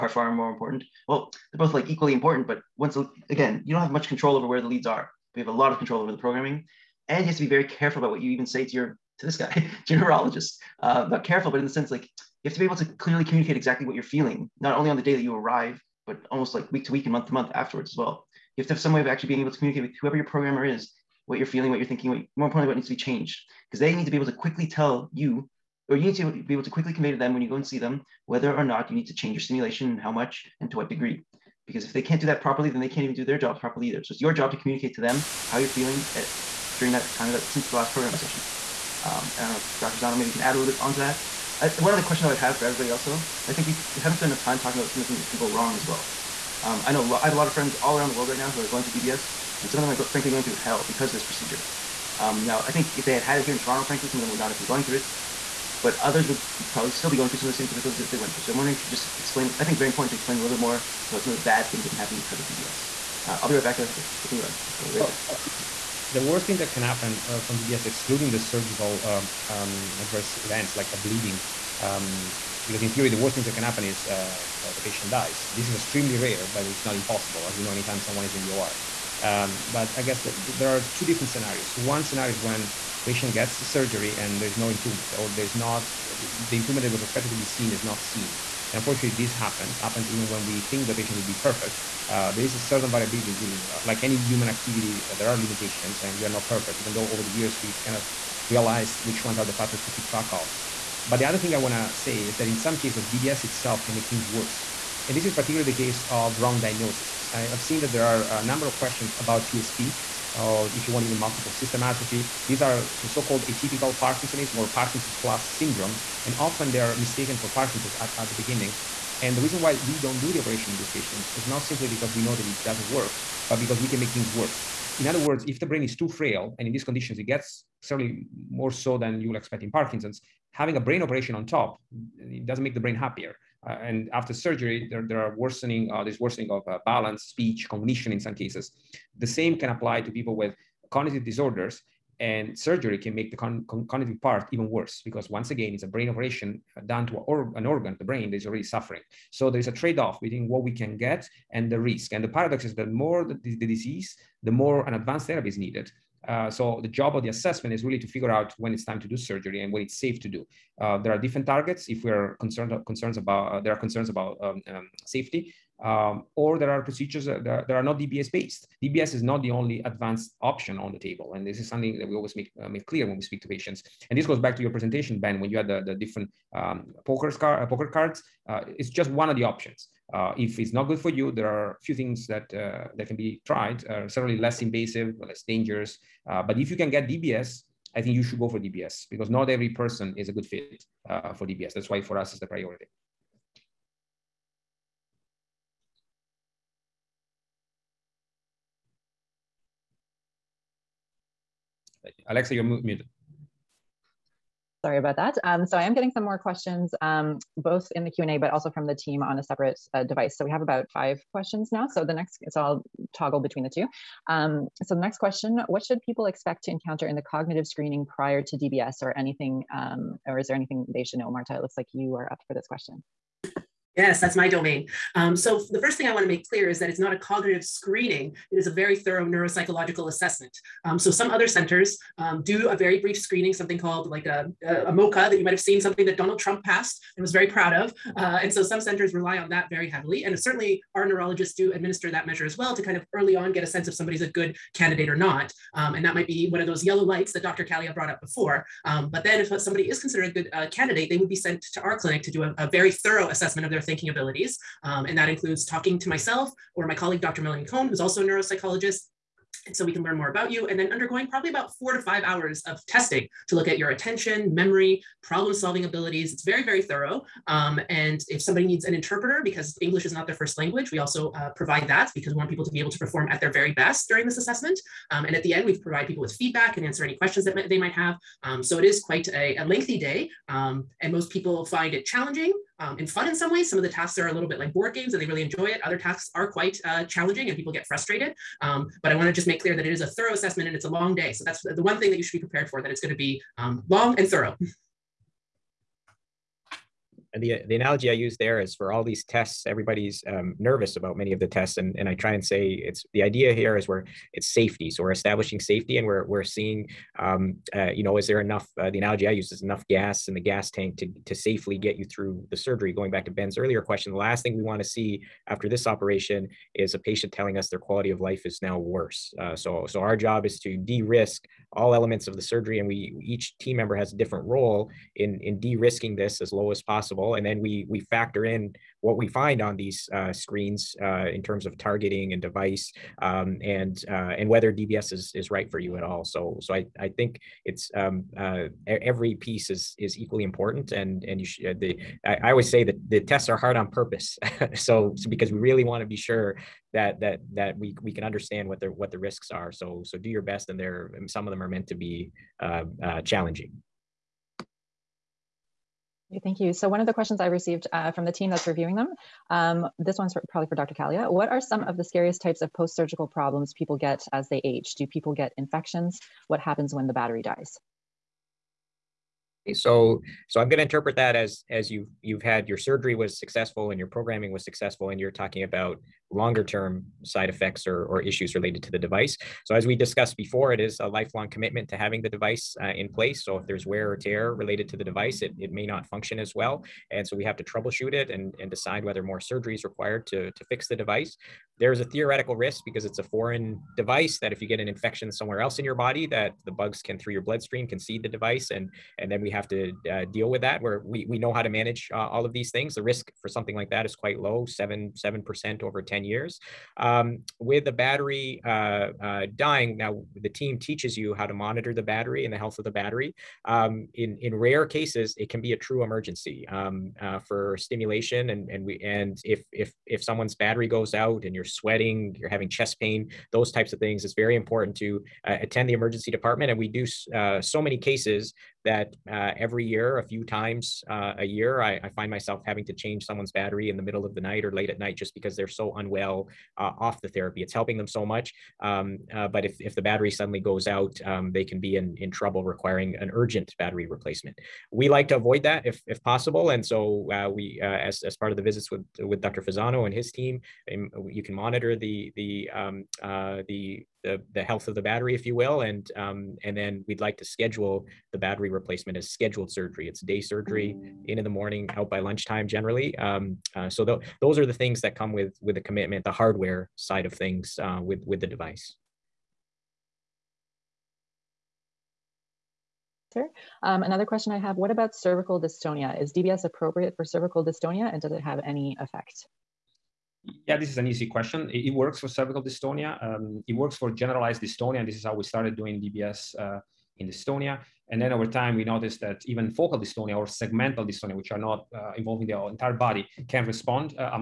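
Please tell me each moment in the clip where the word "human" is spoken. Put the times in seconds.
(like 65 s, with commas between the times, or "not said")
94 s.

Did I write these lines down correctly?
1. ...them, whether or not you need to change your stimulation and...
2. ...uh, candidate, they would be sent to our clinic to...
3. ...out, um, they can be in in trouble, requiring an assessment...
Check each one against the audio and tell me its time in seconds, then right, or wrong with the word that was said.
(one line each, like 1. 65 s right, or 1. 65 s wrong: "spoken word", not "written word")
1. 27 s right
2. 250 s right
3. 440 s wrong: "urgent", not "assessment".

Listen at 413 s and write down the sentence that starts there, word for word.
Um, in, in rare cases, it can be a true emergency um, uh, for stimulation.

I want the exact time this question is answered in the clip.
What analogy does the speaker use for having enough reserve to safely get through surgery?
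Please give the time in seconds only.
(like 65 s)
309 s.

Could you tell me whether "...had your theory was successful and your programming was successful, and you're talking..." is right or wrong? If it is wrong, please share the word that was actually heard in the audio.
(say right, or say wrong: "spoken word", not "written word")
wrong: "surgery", not "theory".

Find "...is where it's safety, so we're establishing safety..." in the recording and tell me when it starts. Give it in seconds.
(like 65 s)
303 s.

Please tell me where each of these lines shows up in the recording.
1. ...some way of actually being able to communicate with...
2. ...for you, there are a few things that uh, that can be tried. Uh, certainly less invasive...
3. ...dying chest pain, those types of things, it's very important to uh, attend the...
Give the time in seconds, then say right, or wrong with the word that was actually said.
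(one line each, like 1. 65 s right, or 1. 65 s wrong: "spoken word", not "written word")
1. 18 s right
2. 180 s right
3. 422 s wrong: "having", not "dying".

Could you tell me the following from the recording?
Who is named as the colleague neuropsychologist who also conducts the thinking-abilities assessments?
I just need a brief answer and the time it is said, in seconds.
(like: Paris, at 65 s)
Dr. Melanie Cohn, at 257 s.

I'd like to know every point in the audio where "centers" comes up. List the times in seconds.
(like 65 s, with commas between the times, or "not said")
231 s, 238 s.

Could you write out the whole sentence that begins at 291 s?
So that's the one thing that you should be prepared for that it's going to be um, long and thorough.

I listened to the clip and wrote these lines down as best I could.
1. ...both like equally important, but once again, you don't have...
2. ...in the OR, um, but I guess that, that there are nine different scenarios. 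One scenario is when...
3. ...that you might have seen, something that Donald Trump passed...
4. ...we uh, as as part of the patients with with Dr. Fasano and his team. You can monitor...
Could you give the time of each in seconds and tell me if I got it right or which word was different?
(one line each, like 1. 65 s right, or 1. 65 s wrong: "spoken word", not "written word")
1. 1 s right
2. 78 s wrong: "two", not "nine"
3. 235 s right
4. 447 s wrong: "visits", not "patients".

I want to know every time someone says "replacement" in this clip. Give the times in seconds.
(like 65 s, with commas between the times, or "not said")
444 s, 458 s.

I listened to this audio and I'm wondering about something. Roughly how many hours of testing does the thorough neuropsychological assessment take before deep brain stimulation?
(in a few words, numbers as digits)
4 to 5 hours.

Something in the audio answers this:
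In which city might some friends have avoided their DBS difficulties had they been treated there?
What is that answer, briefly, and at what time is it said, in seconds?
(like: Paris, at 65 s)
Toronto, at 53 s.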